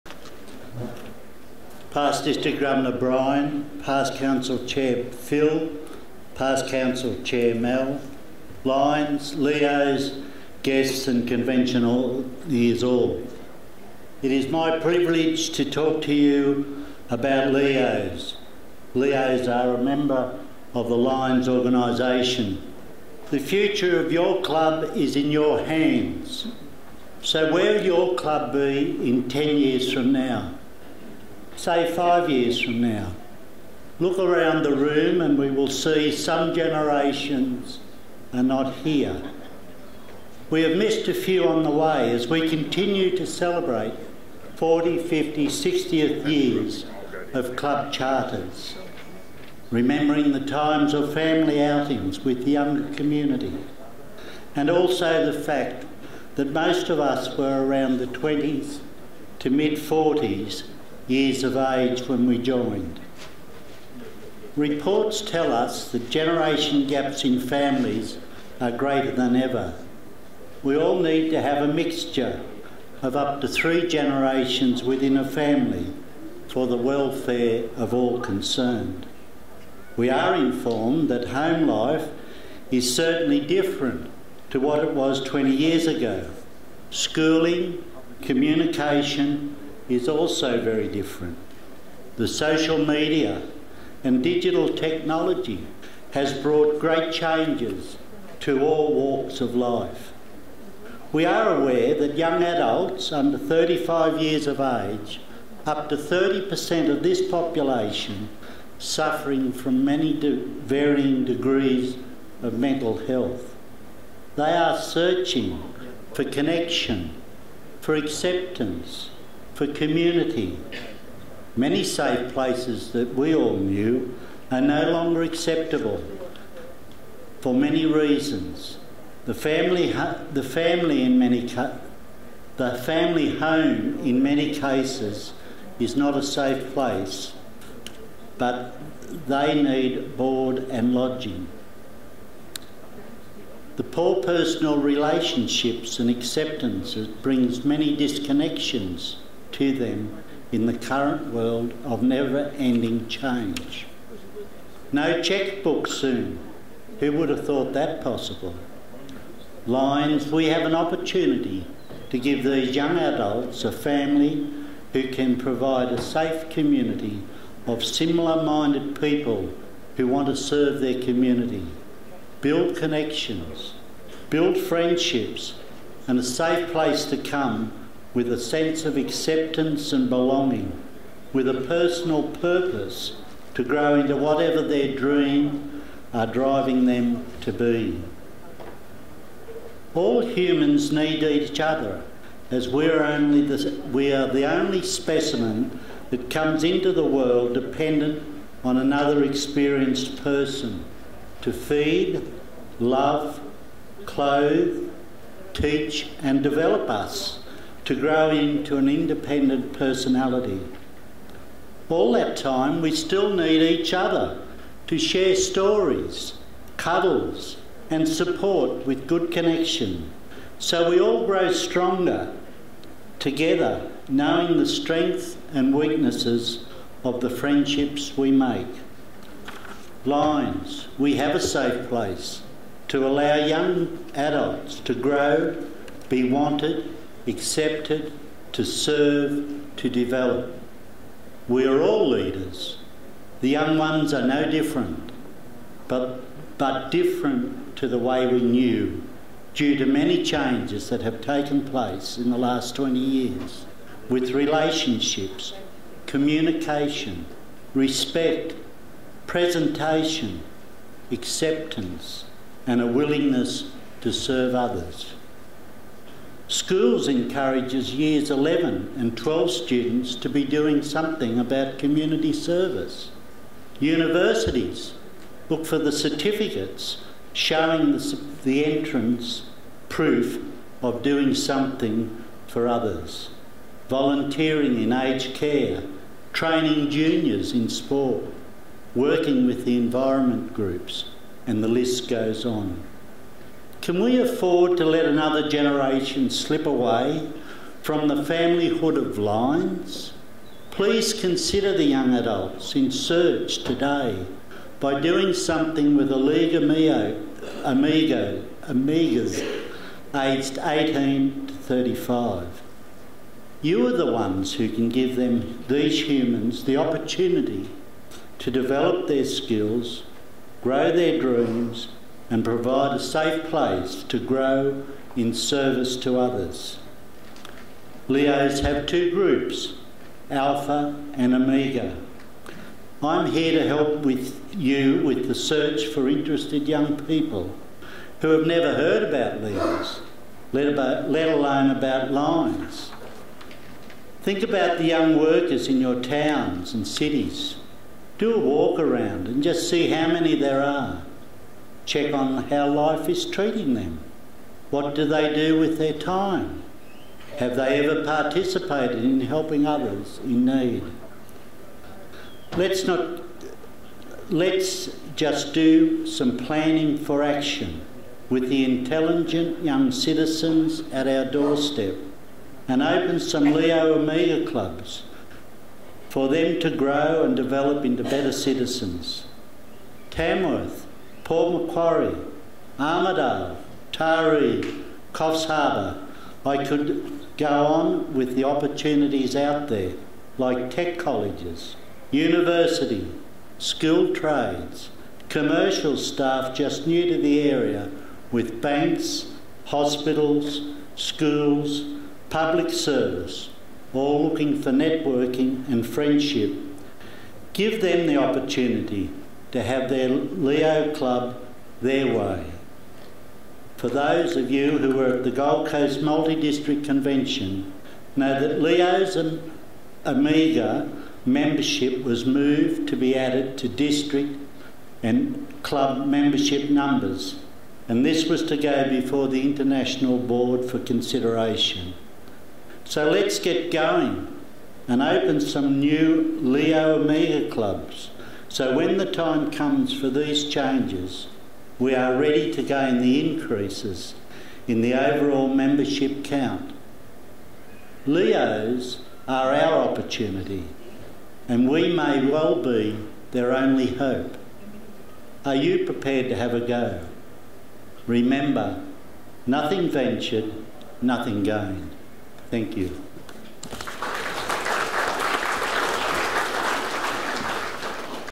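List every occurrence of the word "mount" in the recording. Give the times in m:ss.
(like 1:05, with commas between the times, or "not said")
not said.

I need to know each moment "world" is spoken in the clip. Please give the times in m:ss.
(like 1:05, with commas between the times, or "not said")
2:31, 3:17.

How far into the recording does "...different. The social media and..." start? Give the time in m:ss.
1:30.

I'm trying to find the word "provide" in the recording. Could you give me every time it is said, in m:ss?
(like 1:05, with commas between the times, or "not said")
2:45, 5:22.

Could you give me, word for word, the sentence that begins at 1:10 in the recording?
We all need to have a mixture of up to three generations within a family for the welfare of all concerned.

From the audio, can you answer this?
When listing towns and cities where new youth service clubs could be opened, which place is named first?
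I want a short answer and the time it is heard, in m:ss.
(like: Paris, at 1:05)
Tamworth, at 6:20.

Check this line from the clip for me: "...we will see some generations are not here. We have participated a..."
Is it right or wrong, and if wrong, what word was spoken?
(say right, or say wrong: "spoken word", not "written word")
wrong: "missed", not "participated".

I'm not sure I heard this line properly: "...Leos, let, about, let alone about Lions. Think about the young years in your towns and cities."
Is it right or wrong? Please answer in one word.
wrong.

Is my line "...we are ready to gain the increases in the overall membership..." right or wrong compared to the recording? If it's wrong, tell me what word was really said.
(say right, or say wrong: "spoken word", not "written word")
right.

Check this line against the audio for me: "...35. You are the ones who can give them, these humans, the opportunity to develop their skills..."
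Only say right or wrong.
right.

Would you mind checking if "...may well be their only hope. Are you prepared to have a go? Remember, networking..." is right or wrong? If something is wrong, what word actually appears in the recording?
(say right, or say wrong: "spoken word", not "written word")
wrong: "nothing", not "networking".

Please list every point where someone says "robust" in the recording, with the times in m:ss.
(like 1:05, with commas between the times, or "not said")
not said.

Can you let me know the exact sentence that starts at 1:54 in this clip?
They are searching for connection, for acceptance, for community.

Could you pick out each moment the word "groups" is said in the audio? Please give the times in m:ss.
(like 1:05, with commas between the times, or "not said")
4:50, 5:29.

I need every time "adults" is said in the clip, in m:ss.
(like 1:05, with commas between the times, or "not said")
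1:42, 2:42, 3:54, 5:02.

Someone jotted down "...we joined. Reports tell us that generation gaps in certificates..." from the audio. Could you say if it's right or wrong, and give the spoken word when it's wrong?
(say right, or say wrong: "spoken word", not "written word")
wrong: "families", not "certificates".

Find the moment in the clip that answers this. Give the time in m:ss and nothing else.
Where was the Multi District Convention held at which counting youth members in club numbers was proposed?
6:55.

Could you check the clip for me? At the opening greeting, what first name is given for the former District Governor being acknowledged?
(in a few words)
Brian.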